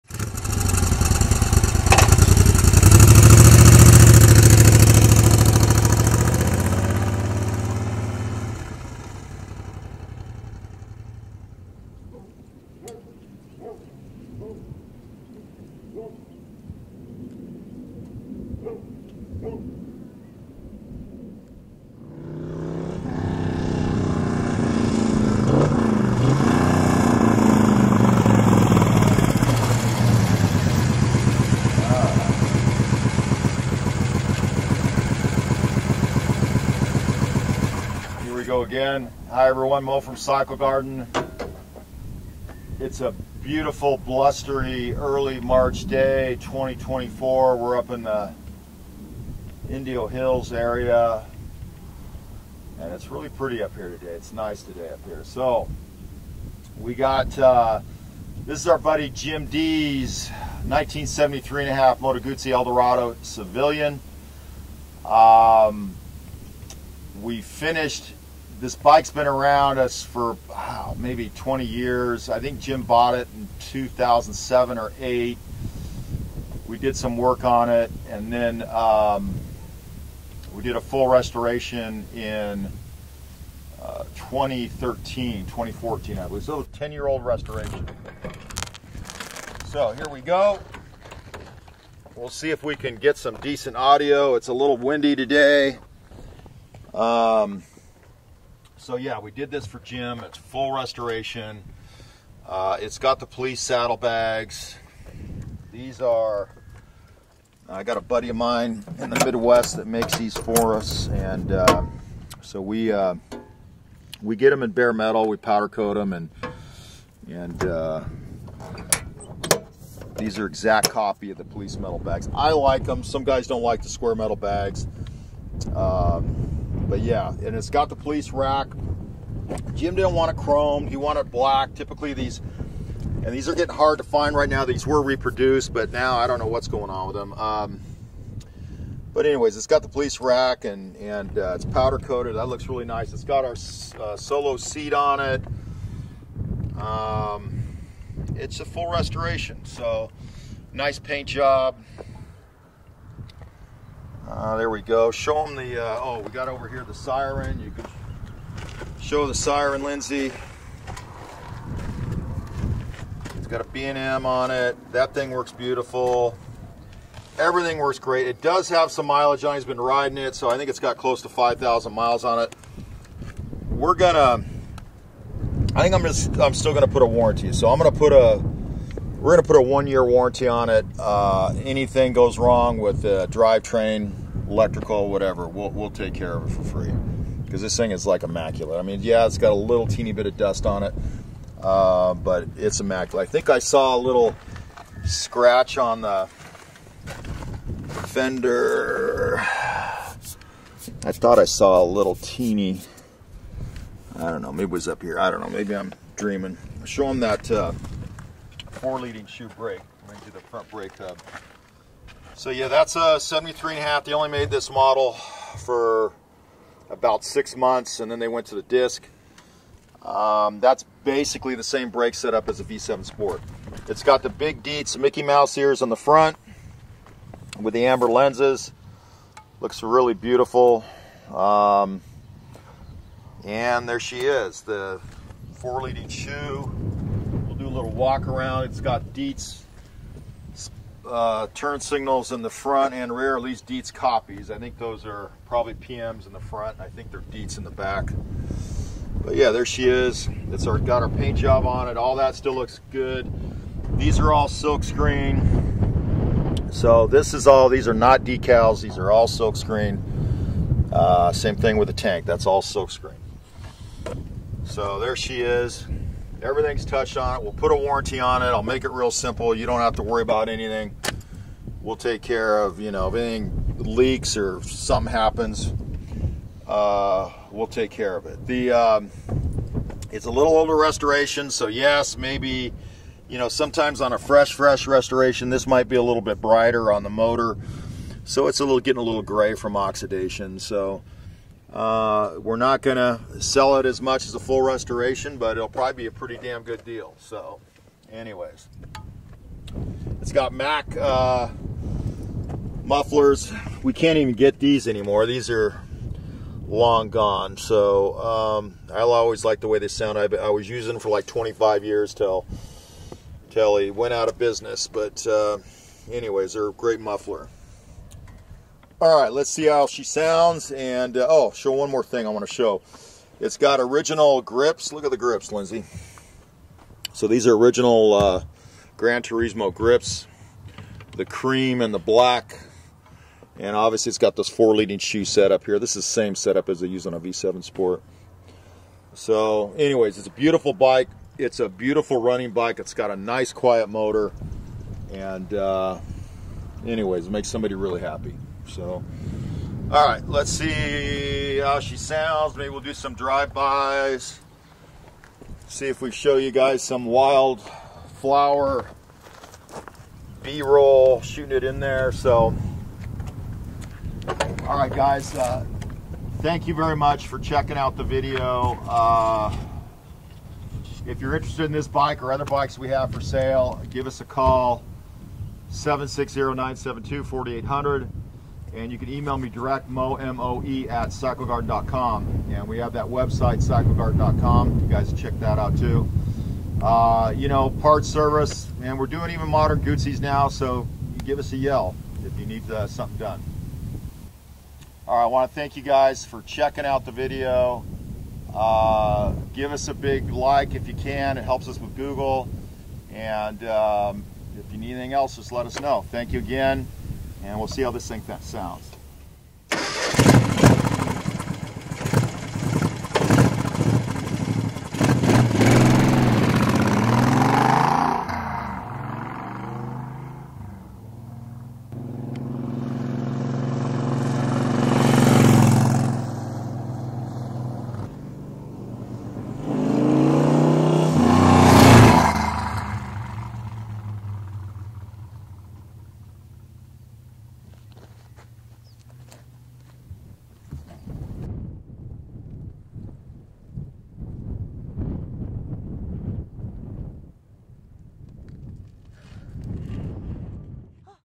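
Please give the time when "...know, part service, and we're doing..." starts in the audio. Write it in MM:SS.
06:27.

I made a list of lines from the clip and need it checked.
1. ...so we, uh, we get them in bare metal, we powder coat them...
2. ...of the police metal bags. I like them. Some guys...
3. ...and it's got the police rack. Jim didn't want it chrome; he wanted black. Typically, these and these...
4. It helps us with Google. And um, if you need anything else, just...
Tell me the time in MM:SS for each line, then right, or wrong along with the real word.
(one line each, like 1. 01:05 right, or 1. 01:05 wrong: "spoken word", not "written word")
1. 01:52 right
2. 02:01 right
3. 02:07 right
4. 06:41 right.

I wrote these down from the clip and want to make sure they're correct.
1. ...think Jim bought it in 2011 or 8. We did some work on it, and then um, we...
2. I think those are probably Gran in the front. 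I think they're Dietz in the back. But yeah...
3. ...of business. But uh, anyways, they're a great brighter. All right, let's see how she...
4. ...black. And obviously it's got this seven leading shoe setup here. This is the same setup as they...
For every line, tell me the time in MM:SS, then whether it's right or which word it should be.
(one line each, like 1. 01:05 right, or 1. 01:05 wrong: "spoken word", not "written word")
1. 01:12 wrong: "2007", not "2011"
2. 04:04 wrong: "PMs", not "Gran"
3. 05:14 wrong: "muffler", not "brighter"
4. 05:31 wrong: "four", not "seven".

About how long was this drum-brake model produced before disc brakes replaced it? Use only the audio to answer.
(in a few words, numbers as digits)
About six months.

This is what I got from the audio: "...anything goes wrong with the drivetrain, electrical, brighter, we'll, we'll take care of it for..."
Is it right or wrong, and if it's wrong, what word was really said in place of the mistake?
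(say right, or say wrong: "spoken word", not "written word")
wrong: "whatever", not "brighter".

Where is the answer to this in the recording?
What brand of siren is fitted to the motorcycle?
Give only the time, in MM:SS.
02:43.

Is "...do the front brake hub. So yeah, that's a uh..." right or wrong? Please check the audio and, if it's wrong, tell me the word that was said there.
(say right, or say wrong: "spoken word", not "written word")
right.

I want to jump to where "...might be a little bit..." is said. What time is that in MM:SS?
04:45.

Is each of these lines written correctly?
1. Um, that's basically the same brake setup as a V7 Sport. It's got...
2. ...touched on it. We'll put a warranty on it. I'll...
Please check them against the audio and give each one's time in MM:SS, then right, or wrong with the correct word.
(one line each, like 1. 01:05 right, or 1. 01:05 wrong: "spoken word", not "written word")
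1. 03:40 right
2. 04:26 right.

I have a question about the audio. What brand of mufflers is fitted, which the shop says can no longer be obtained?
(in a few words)
Mac.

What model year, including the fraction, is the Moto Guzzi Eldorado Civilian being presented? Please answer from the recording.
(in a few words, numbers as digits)
1973 and a half.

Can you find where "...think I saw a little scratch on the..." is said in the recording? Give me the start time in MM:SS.
03:13.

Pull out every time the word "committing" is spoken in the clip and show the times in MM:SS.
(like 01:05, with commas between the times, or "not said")
not said.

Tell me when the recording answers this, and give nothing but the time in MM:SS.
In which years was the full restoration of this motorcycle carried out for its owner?
01:24.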